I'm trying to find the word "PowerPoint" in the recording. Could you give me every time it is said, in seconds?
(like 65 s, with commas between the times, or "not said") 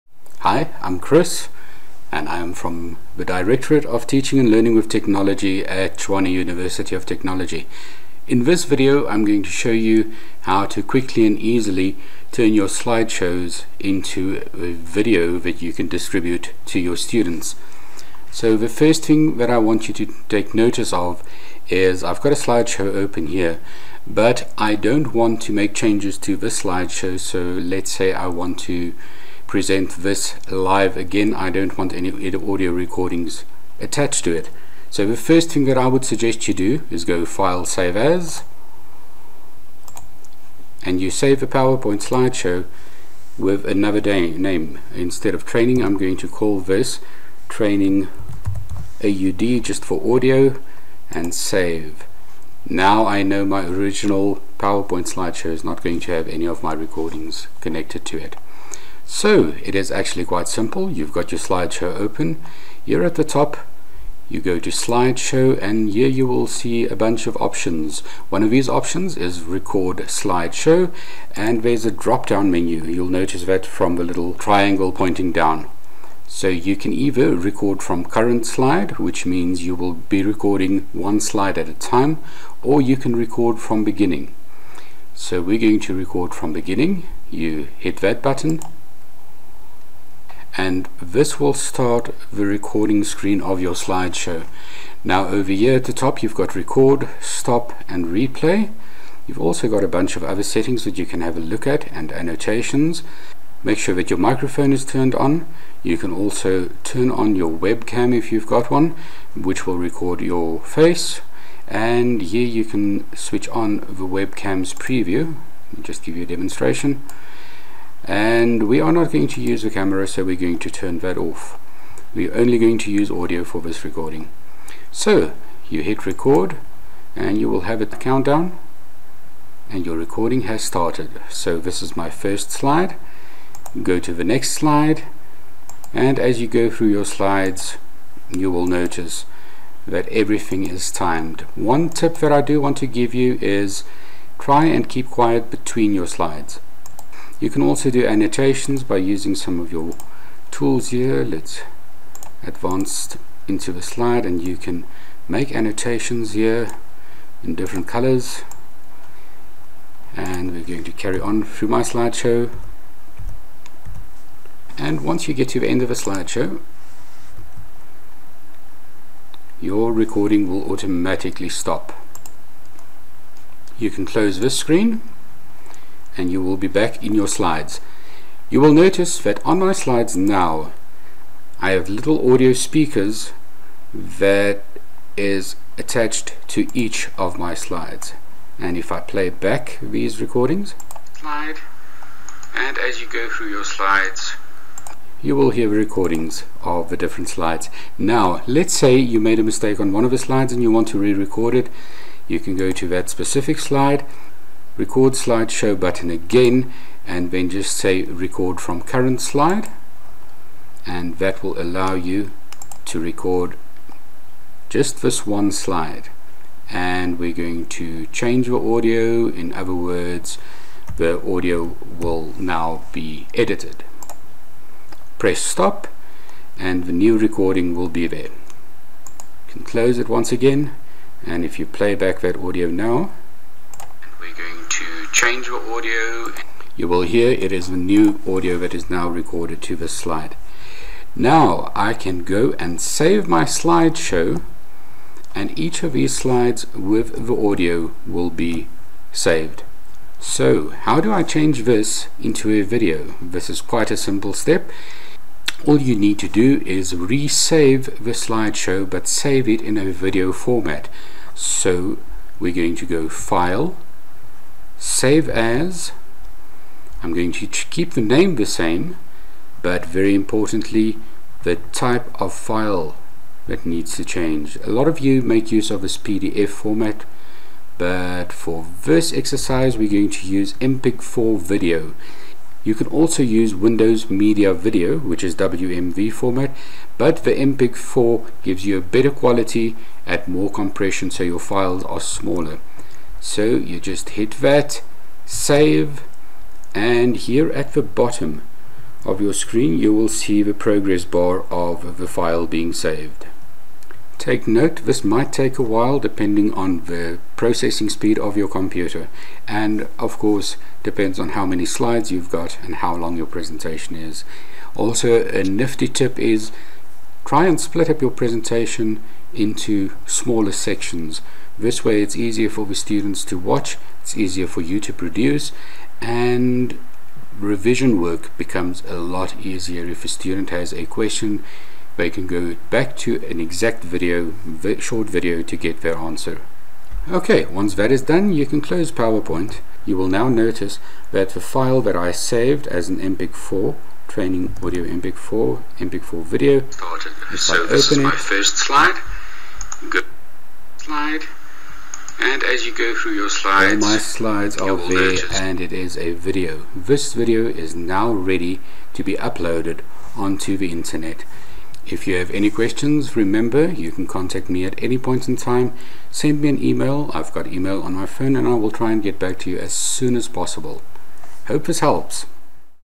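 41 s, 54 s, 338 s.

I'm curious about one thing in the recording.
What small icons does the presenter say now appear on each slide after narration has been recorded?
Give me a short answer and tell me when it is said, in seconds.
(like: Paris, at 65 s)
audio speakers, at 182 s.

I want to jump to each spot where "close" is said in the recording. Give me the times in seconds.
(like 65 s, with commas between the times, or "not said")
174 s, 229 s, 338 s.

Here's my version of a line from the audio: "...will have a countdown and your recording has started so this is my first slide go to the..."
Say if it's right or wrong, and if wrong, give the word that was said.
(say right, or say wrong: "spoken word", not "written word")
right.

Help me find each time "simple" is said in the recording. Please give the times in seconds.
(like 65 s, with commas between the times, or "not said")
60 s, 253 s.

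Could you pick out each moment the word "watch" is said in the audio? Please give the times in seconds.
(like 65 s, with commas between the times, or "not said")
323 s.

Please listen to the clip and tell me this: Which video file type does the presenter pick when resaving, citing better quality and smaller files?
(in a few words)
MPEG-4.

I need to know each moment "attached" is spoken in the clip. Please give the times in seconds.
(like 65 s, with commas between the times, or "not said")
33 s, 185 s.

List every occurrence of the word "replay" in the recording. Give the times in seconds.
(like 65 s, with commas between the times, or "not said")
98 s.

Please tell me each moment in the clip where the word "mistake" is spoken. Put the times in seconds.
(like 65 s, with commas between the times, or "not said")
199 s.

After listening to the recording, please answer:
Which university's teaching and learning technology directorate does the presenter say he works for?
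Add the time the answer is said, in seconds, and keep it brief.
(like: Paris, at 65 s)
Tshwane University of Technology, at 5 s.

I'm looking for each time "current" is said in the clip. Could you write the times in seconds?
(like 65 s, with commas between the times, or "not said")
78 s, 208 s.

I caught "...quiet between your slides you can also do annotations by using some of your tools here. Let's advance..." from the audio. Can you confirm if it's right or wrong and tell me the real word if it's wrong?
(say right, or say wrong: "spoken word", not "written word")
right.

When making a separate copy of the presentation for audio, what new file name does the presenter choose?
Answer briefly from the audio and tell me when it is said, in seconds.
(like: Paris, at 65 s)
training AUD, at 47 s.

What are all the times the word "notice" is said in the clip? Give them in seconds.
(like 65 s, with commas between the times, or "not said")
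20 s, 73 s, 138 s, 178 s, 340 s.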